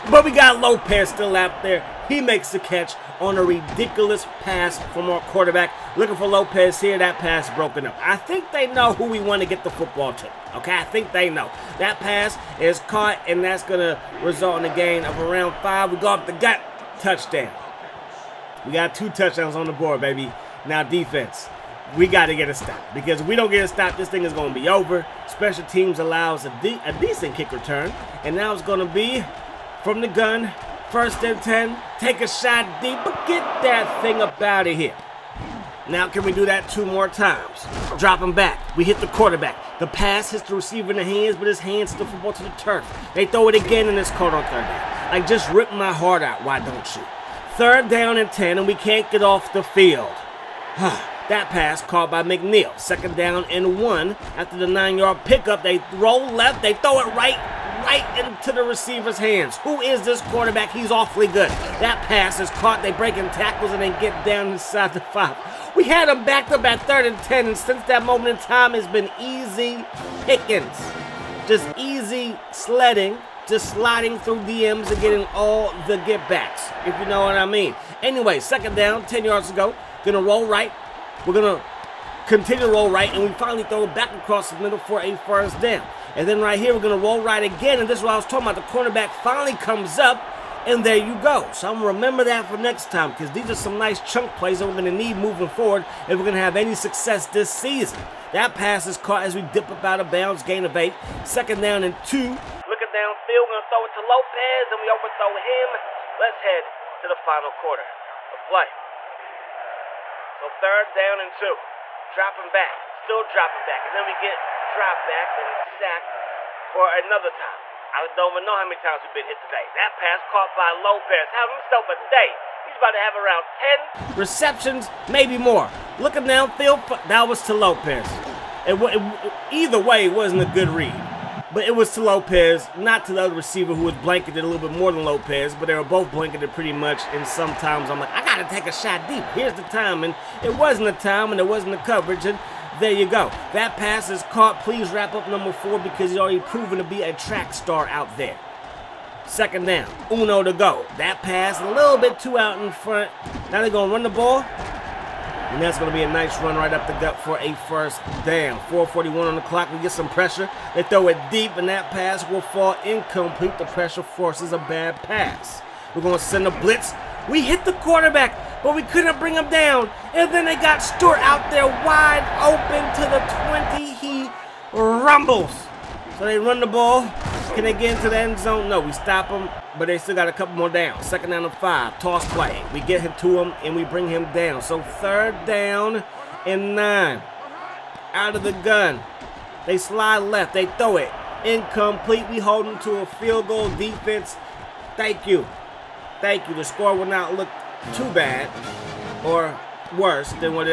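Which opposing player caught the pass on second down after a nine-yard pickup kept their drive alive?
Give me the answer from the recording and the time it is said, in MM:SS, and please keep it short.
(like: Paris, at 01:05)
McNeil, at 00:52.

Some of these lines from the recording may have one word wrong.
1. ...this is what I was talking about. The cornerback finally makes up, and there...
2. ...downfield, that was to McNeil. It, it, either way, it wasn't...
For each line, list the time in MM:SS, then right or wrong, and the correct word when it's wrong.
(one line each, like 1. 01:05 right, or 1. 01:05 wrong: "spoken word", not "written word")
1. 01:27 wrong: "comes", not "makes"
2. 02:06 wrong: "Lopez", not "McNeil".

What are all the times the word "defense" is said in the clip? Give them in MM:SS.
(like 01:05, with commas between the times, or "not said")
00:20, 03:13.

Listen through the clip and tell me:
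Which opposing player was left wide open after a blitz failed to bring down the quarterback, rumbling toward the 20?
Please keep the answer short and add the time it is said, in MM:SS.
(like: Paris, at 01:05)
Stewart, at 02:50.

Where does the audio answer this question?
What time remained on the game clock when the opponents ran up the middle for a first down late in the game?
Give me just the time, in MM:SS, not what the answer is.
02:38.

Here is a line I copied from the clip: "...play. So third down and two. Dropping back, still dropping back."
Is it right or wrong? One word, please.
right.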